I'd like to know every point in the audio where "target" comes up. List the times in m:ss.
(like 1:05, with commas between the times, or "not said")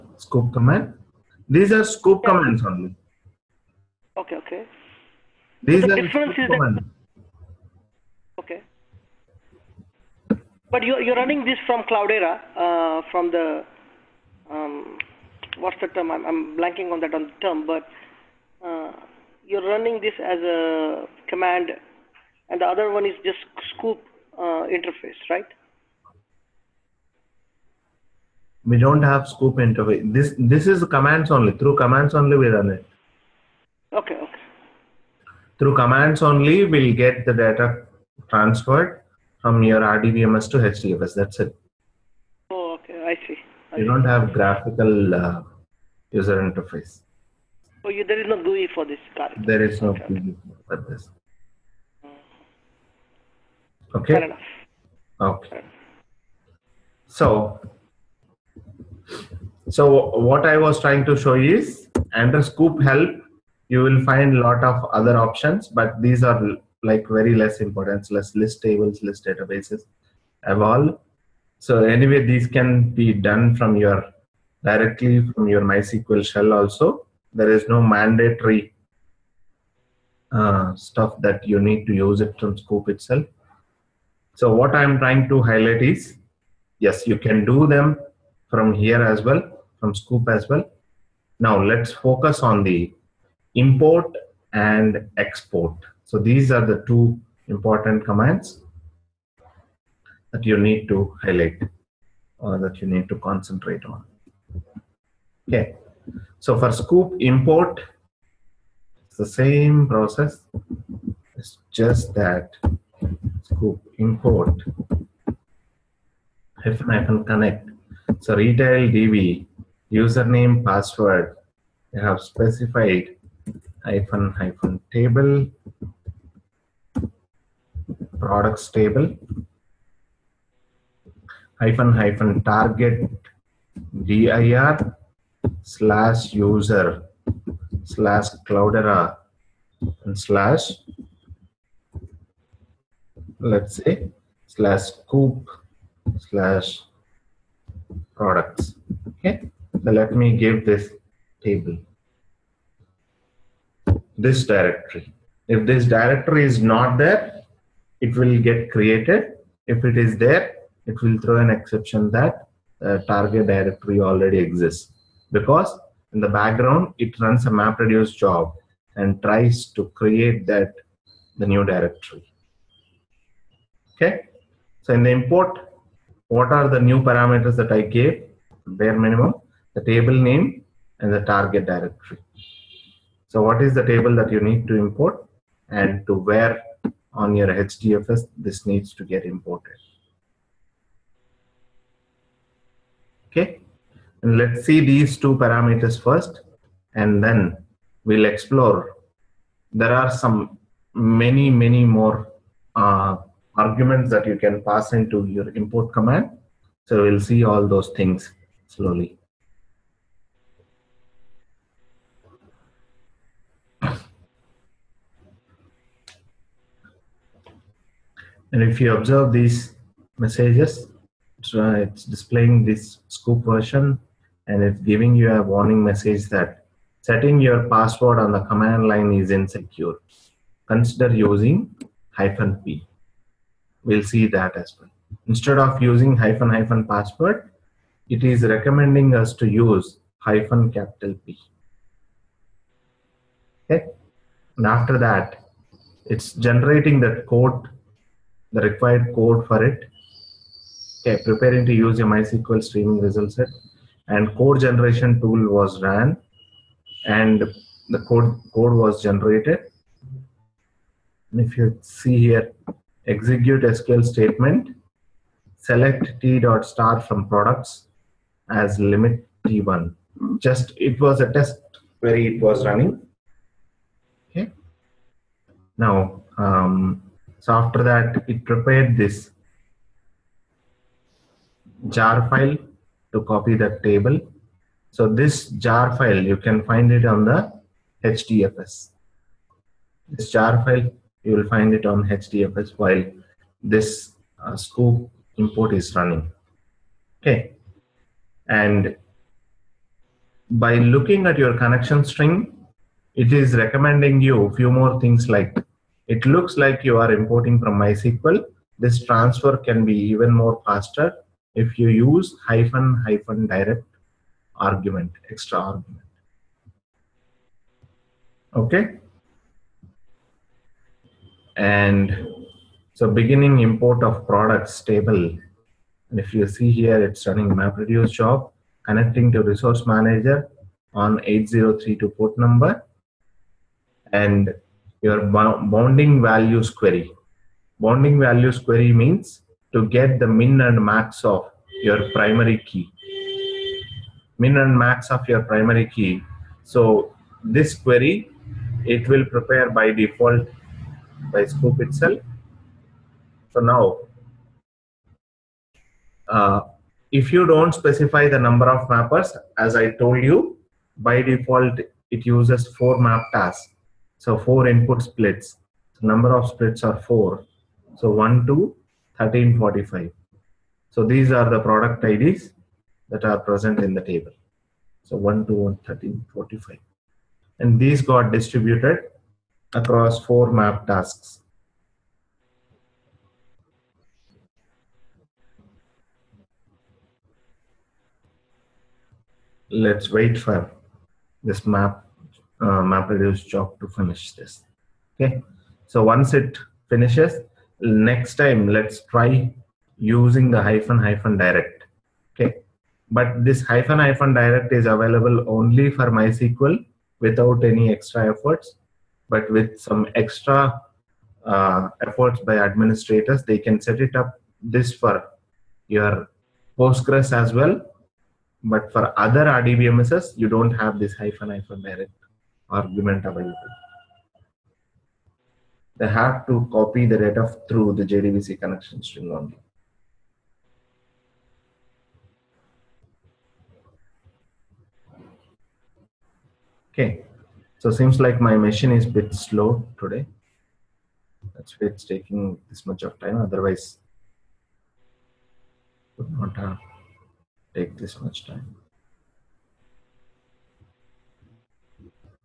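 2:12, 2:43, 3:01.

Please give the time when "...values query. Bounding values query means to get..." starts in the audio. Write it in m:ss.
5:36.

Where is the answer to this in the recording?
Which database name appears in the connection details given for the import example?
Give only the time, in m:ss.
1:58.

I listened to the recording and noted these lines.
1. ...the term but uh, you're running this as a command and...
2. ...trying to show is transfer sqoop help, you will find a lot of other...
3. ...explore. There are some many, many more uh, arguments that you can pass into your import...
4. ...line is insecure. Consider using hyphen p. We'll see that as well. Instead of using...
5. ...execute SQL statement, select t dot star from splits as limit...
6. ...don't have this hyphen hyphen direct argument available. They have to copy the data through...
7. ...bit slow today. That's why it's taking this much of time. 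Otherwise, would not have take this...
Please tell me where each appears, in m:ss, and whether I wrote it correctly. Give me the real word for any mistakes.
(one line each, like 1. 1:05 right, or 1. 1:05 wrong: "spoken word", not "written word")
1. 0:17 right
2. 1:00 wrong: "under", not "transfer"
3. 3:18 right
4. 3:48 right
5. 4:23 wrong: "products", not "splits"
6. 7:00 right
7. 7:19 right.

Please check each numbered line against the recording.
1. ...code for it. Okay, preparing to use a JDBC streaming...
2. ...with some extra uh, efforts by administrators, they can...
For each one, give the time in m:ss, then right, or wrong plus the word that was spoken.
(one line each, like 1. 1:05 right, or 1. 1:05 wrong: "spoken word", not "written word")
1. 4:09 wrong: "MySQL", not "JDBC"
2. 6:49 right.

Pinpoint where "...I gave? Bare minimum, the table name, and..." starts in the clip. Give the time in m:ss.
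2:57.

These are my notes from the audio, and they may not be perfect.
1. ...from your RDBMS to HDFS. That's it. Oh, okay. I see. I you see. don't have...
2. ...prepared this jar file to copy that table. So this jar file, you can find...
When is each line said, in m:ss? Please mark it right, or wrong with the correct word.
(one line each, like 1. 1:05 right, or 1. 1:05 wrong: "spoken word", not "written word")
1. 0:39 right
2. 4:38 right.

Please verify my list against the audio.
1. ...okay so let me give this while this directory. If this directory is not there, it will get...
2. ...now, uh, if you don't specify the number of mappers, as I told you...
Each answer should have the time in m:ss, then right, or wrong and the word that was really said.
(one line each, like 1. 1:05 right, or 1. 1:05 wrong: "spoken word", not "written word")
1. 2:29 wrong: "table", not "while"
2. 5:53 right.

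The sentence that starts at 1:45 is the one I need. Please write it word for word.
Okay, so for sqoop import, it's the same process.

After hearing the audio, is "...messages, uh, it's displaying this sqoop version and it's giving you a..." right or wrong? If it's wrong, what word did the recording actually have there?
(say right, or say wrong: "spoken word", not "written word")
right.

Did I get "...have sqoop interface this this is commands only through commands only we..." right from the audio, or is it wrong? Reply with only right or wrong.
right.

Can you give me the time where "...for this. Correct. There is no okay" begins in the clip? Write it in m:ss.
0:48.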